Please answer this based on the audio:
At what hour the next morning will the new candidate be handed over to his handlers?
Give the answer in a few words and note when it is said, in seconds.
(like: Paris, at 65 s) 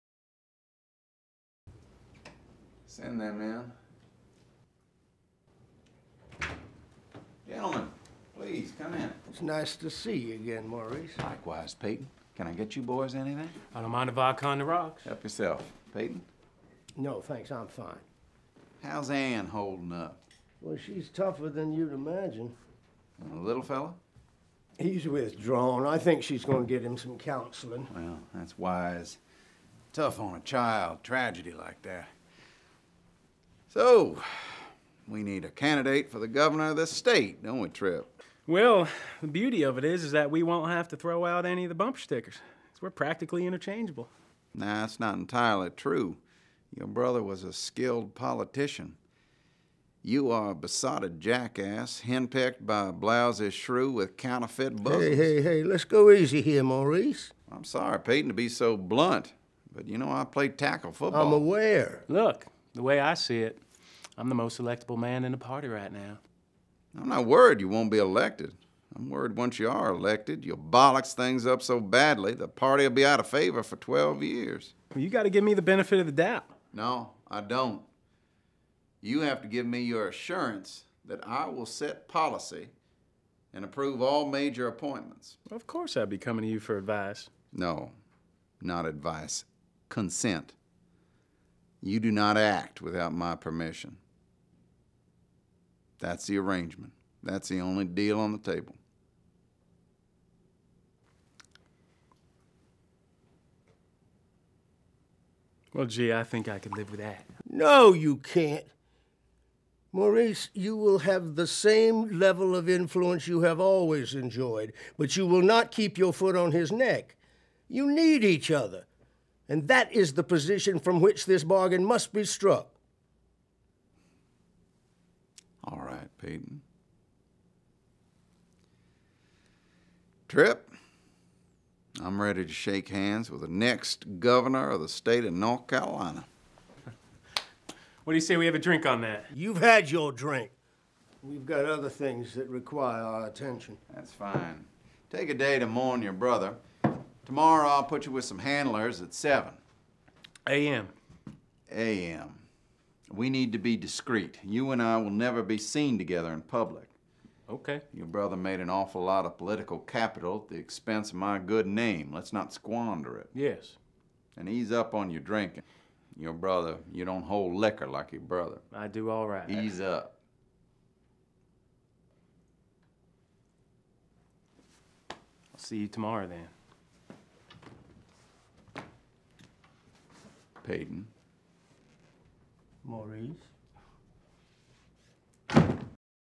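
7 A.M., at 149 s.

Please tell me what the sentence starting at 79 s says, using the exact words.
You have to give me your assurance that I will set policy and approve all major appointments.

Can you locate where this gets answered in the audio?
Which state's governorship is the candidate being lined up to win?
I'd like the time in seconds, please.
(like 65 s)
135 s.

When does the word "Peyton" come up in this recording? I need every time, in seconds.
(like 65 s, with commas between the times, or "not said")
11 s, 15 s, 58 s, 126 s, 180 s.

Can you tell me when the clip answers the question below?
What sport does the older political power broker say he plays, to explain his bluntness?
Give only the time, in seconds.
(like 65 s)
60 s.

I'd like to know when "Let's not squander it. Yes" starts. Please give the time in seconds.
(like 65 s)
162 s.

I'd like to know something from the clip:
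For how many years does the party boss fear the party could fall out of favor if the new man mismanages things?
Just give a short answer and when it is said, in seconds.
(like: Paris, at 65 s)
12, at 73 s.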